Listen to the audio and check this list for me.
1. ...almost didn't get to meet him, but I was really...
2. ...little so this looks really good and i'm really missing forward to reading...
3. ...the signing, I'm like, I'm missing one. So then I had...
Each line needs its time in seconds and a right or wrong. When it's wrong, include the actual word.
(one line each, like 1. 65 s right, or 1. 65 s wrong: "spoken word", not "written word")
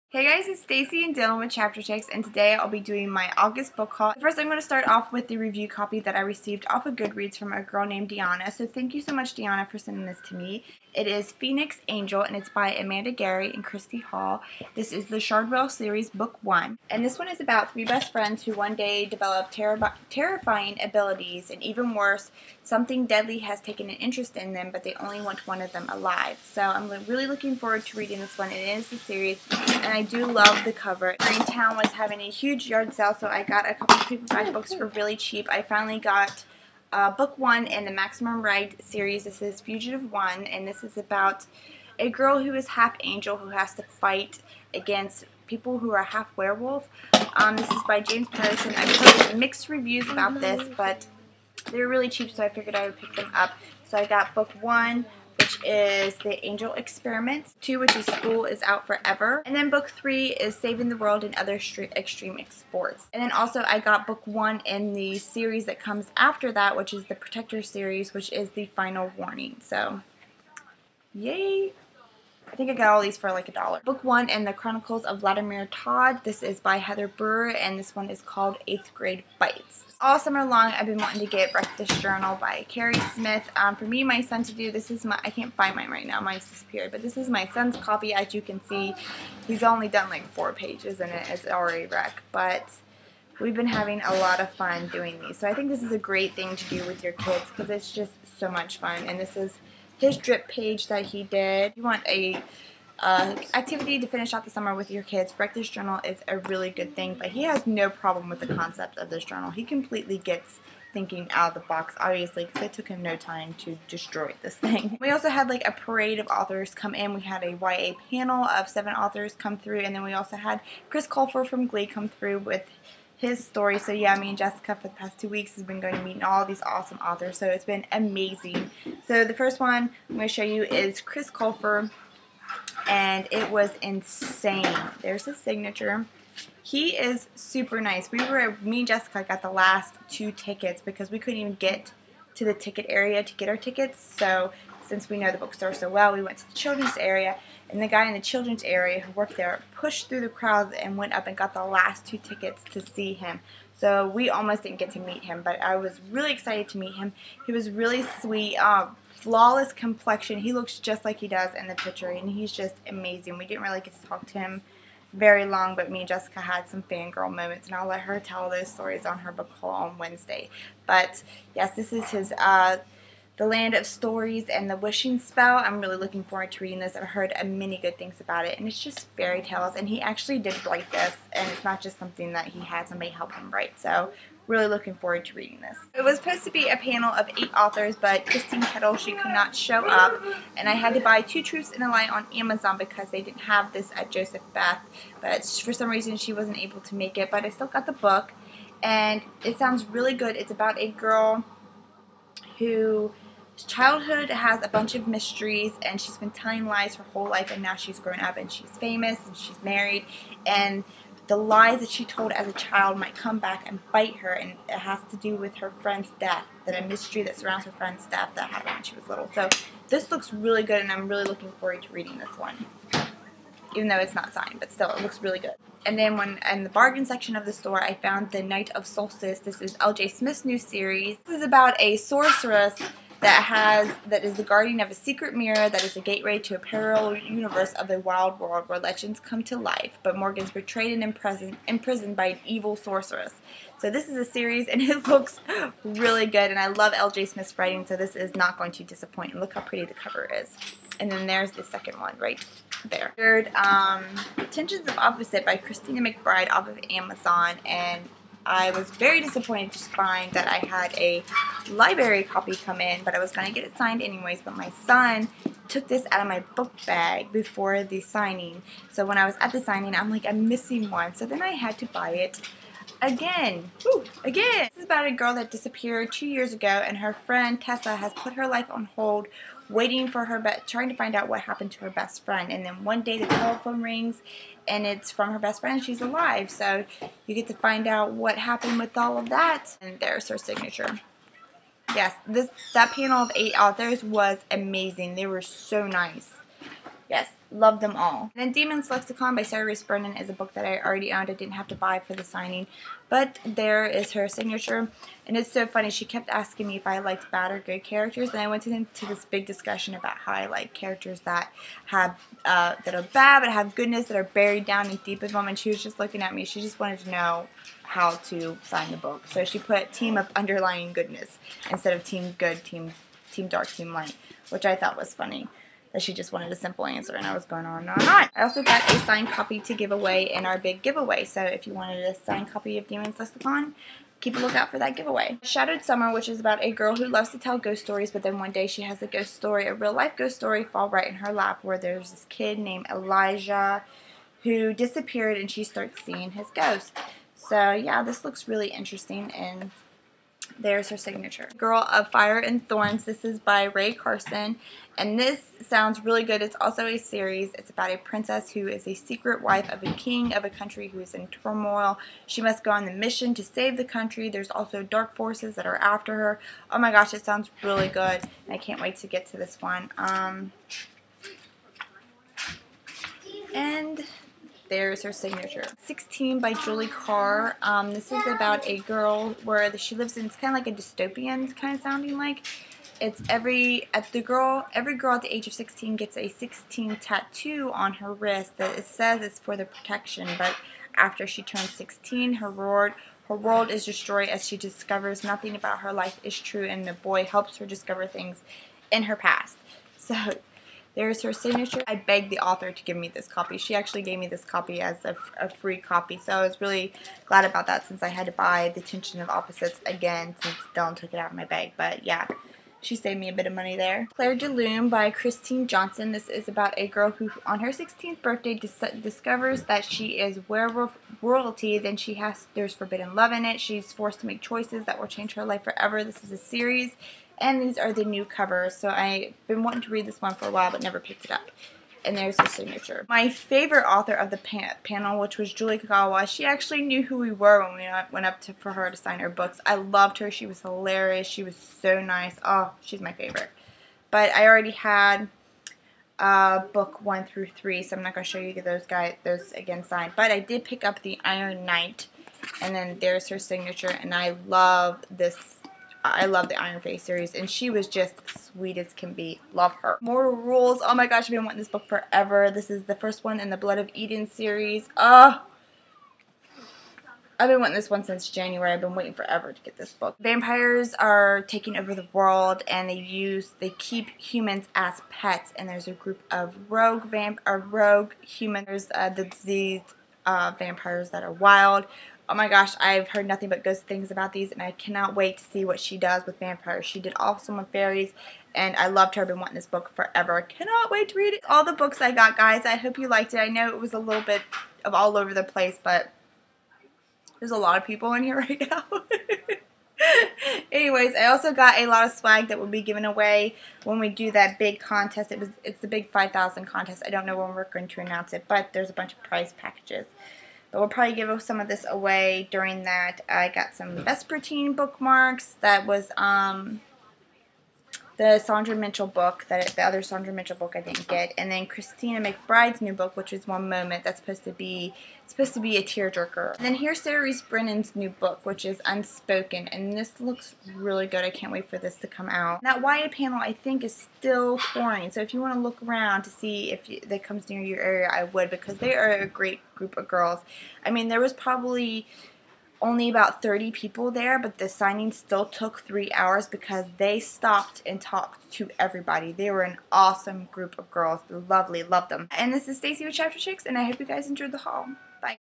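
1. 154 s right
2. 219 s wrong: "looking", not "missing"
3. 269 s right.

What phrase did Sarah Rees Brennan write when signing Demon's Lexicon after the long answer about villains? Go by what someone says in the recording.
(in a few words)
team of underlying goodness.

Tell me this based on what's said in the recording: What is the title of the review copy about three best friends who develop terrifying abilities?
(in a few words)
Phoenix Angel.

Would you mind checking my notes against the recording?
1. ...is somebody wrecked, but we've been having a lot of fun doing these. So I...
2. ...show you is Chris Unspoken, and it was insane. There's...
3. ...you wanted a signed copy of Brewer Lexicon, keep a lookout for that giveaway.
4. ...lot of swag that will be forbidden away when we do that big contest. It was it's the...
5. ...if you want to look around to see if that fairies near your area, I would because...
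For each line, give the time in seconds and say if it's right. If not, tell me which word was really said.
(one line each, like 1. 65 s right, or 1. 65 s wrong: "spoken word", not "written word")
1. 91 s wrong: "already", not "somebody"
2. 130 s wrong: "Colfer", not "Unspoken"
3. 331 s wrong: "Demons", not "Brewer"
4. 501 s wrong: "given", not "forbidden"
5. 535 s wrong: "comes", not "fairies".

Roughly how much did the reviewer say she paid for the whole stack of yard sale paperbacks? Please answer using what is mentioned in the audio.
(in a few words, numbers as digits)
a dollar.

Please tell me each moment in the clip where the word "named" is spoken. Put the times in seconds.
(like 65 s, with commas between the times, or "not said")
7 s, 342 s.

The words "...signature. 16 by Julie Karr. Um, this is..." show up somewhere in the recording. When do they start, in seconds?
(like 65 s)
375 s.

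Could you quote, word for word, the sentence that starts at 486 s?
She did awesome with fairies, and I loved her.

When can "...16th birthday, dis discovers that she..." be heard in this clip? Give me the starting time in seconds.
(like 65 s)
417 s.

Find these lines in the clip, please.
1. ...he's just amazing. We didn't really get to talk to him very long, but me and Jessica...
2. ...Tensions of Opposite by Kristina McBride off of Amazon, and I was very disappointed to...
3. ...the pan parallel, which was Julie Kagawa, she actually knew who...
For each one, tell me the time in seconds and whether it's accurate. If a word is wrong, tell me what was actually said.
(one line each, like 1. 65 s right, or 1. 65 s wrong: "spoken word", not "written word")
1. 162 s right
2. 254 s right
3. 434 s wrong: "panel", not "parallel".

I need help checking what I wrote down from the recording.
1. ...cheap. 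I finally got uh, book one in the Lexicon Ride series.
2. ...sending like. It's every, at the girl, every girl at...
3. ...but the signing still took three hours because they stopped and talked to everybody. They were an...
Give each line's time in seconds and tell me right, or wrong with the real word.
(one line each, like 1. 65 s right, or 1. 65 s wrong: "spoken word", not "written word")
1. 35 s wrong: "Maximum", not "Lexicon"
2. 381 s wrong: "sounding", not "sending"
3. 544 s right.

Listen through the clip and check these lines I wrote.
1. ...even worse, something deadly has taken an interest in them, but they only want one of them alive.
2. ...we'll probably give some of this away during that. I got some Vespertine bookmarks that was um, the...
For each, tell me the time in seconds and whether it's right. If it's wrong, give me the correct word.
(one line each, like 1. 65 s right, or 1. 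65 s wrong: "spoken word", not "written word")
1. 21 s right
2. 510 s right.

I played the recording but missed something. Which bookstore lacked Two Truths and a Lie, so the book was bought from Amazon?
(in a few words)
Joseph Beth.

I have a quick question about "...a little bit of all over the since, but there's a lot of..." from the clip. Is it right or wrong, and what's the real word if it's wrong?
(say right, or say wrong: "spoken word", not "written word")
wrong: "place", not "since".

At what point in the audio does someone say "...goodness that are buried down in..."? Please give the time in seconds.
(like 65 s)
313 s.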